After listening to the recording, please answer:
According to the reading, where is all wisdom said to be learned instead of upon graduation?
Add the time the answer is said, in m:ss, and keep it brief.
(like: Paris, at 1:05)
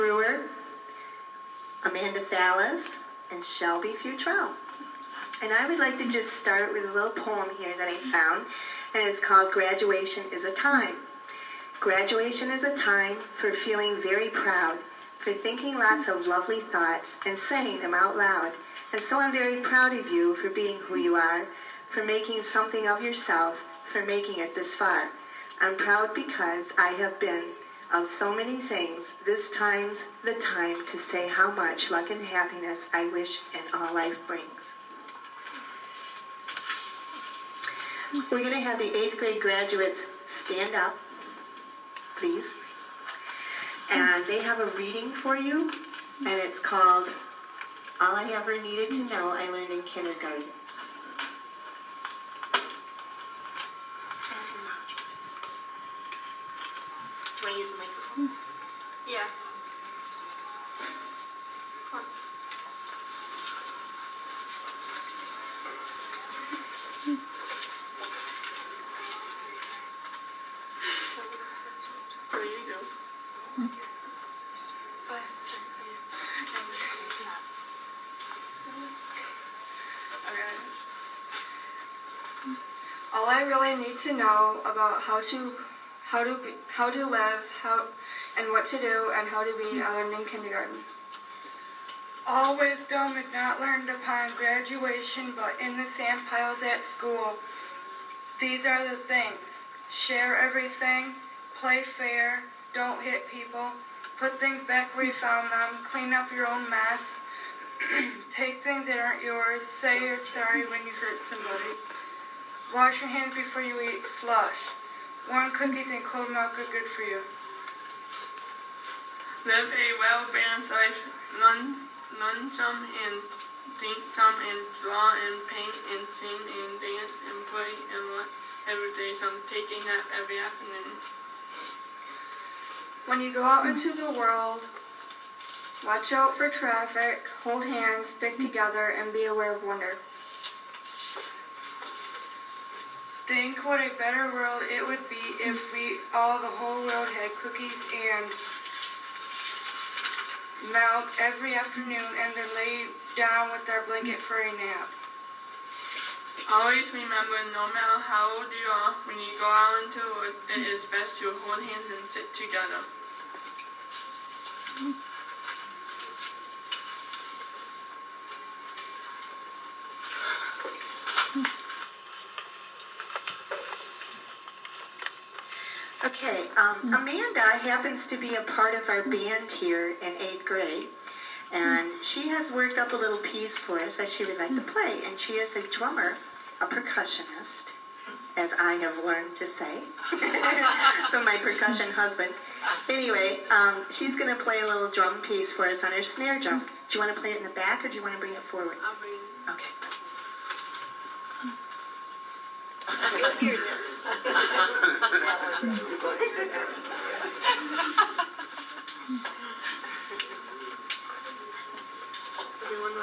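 The sand piles at school, at 1:35.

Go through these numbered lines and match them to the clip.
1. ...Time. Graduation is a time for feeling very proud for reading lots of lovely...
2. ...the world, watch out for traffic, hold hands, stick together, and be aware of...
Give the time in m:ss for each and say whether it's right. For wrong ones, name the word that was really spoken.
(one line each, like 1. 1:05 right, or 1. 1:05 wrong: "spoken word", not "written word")
1. 0:10 wrong: "thinking", not "reading"
2. 2:13 right.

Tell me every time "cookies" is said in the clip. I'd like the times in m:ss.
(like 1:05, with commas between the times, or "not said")
1:55, 2:27.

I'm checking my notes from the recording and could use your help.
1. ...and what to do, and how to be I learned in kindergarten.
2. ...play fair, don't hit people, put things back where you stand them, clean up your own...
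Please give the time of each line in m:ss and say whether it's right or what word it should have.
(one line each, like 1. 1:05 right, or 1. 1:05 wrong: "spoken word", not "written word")
1. 1:28 right
2. 1:41 wrong: "found", not "stand".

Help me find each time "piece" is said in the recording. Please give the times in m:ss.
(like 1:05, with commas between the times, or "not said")
3:03, 3:15.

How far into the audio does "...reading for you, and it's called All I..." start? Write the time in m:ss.
0:44.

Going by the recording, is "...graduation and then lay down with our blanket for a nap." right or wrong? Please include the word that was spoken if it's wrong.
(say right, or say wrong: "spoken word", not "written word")
wrong: "afternoon", not "graduation".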